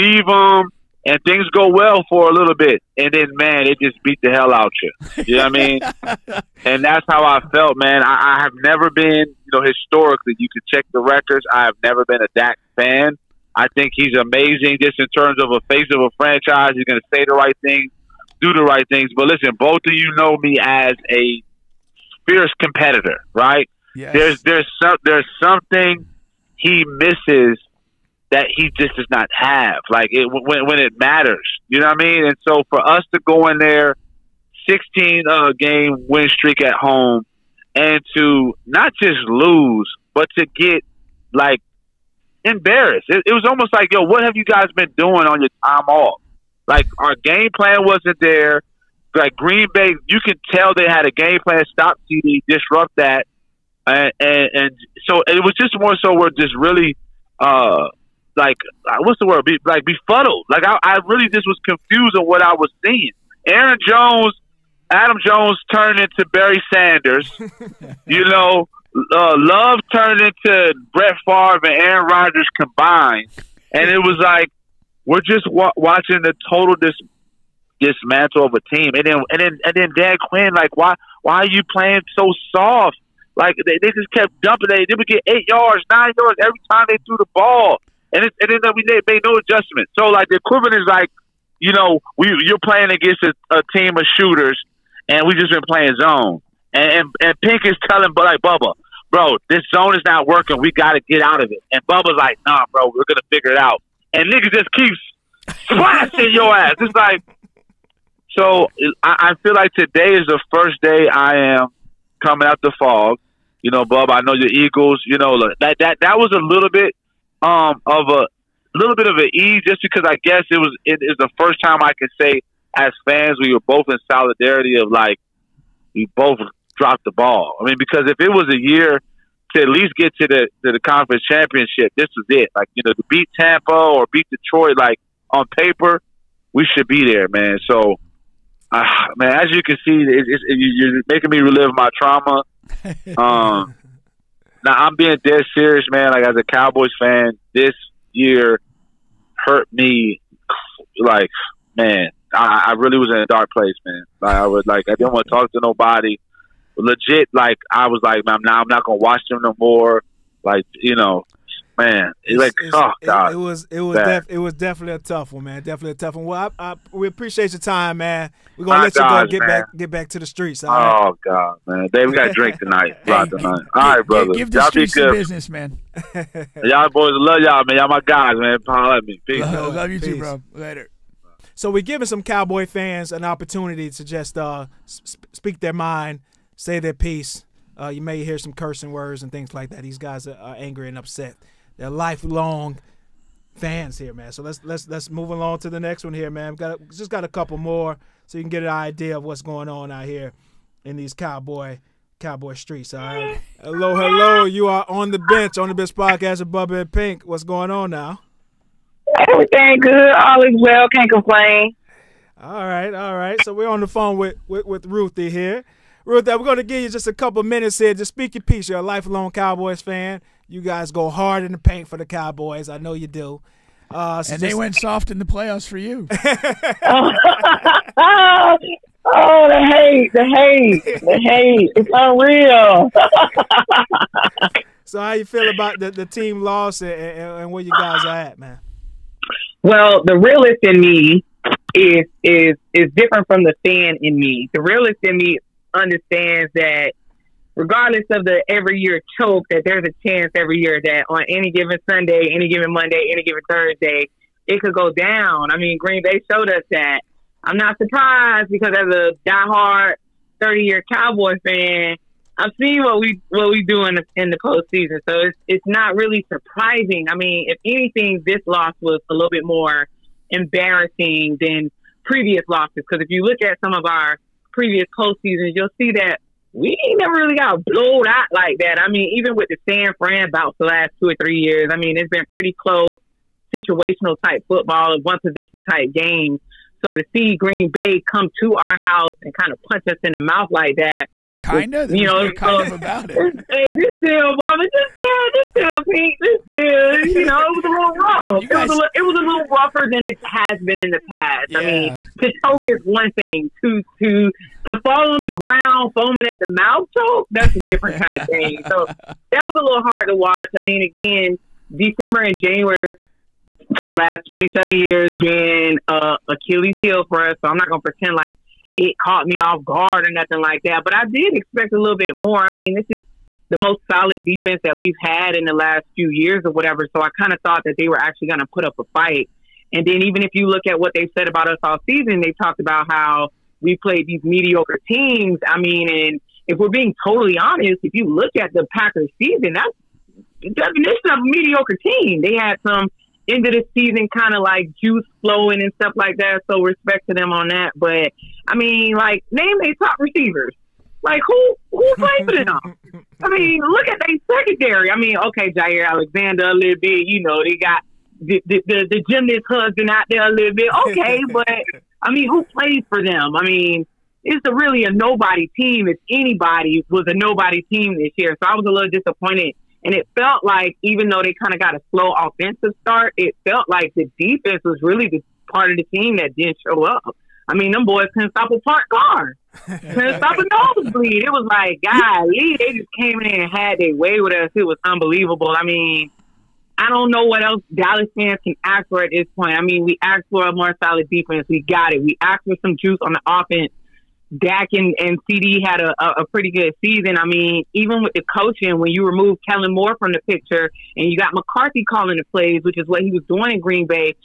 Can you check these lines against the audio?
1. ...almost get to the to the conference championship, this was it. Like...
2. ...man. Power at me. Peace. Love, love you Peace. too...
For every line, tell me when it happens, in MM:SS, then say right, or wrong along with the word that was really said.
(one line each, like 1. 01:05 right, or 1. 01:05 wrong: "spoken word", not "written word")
1. 02:09 wrong: "least", not "almost"
2. 02:58 right.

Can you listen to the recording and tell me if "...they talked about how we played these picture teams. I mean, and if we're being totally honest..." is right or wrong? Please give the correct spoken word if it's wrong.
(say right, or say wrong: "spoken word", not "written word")
wrong: "mediocre", not "picture".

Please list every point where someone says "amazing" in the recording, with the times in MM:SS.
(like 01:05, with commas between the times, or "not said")
00:14.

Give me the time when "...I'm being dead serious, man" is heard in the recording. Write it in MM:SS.
02:24.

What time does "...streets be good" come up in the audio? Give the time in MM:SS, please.
02:54.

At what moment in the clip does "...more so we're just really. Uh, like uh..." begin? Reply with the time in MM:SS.
00:55.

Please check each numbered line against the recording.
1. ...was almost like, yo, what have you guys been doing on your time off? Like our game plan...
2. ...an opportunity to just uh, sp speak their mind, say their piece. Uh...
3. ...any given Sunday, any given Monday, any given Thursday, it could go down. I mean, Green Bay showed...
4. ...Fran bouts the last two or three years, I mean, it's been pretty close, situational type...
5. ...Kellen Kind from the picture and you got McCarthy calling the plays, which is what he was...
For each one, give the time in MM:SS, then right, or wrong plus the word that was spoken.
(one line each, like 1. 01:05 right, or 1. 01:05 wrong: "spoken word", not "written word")
1. 00:43 right
2. 03:03 right
3. 04:11 right
4. 04:39 right
5. 06:39 wrong: "Moore", not "Kind".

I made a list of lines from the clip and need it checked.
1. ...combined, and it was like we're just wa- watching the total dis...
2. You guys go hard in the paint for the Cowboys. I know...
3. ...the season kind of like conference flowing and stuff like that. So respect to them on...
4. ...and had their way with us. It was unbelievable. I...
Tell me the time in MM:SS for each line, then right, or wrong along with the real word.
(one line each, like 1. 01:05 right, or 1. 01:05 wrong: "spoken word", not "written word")
1. 01:12 right
2. 03:40 right
3. 05:43 wrong: "juice", not "conference"
4. 06:23 right.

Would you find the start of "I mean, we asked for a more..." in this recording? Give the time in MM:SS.
06:29.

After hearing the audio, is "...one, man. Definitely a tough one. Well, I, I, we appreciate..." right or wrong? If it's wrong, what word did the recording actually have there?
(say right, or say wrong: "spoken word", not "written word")
right.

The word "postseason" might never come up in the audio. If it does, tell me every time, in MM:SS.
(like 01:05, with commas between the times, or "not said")
04:24, 04:34.